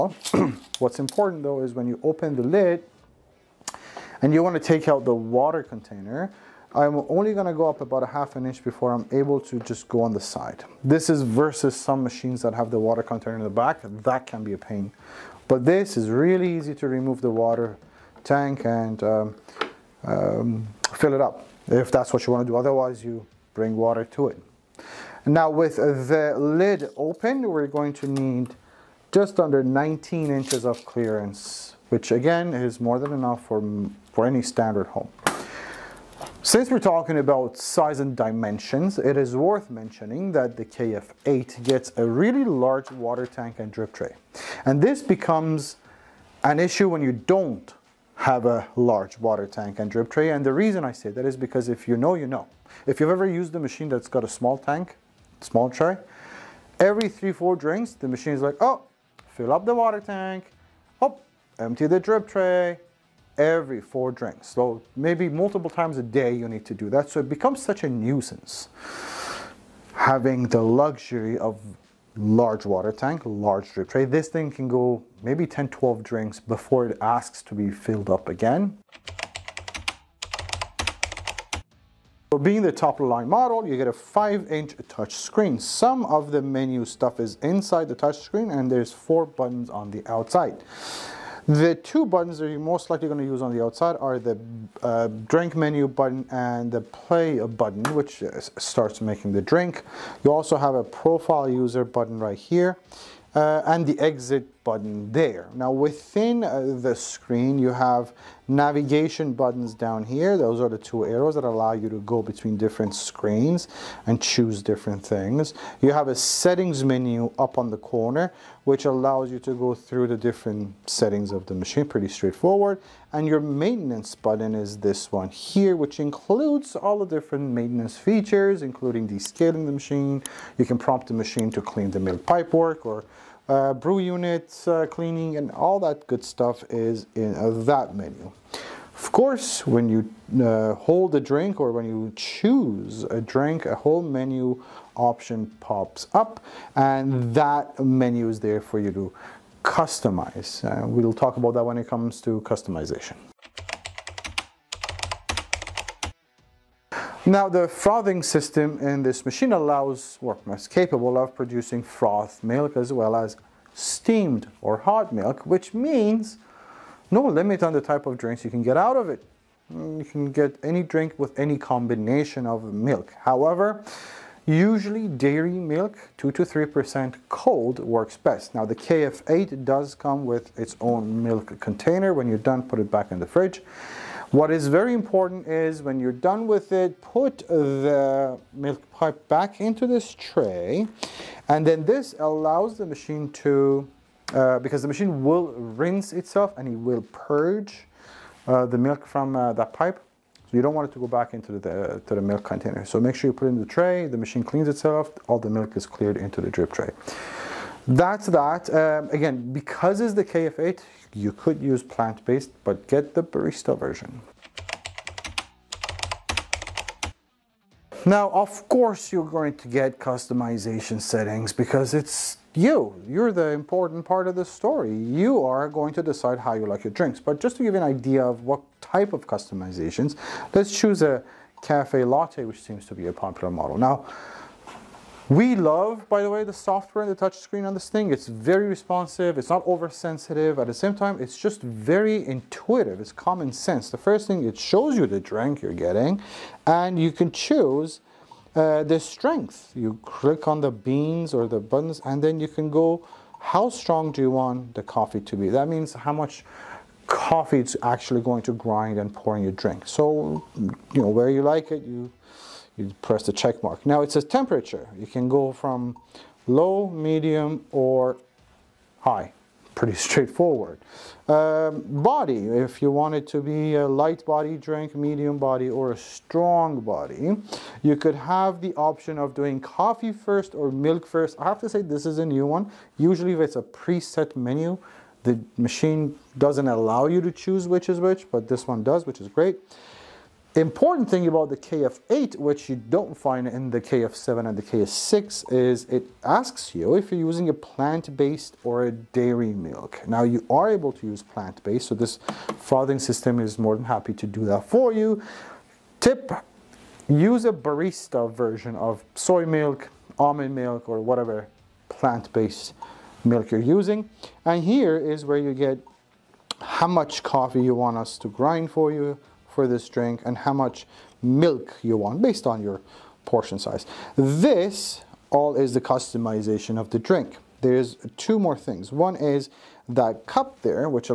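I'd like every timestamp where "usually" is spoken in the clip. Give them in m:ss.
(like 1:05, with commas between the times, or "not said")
2:54, 4:42.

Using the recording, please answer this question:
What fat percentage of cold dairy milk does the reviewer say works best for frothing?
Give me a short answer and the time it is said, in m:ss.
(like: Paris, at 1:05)
2 to 3%, at 2:56.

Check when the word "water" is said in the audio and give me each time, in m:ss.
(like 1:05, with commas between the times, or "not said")
0:05, 0:12, 0:17, 0:23, 0:42, 0:49, 0:59, 1:12.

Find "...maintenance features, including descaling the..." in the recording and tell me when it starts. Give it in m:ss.
2:07.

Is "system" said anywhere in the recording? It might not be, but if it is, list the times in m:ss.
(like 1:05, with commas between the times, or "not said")
2:38, 5:02.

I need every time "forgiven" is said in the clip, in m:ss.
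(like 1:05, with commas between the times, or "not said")
not said.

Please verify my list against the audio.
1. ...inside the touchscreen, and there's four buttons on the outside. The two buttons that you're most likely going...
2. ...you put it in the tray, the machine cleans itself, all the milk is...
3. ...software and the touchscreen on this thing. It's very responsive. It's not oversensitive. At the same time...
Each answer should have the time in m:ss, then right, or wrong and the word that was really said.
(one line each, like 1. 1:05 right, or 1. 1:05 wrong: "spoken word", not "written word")
1. 1:27 right
2. 3:23 right
3. 3:56 right.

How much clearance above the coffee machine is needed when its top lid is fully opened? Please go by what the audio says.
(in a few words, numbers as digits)
just under 19 inches.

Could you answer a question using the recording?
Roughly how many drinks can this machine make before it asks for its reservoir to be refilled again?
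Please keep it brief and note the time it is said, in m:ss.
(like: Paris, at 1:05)
10 to 12, at 1:15.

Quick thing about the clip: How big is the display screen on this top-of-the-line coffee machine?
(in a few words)
5-inch.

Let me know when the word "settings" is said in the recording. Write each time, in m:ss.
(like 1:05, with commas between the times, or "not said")
1:56, 2:00, 3:40.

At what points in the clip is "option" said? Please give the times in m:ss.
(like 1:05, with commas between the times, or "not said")
2:24, 4:38.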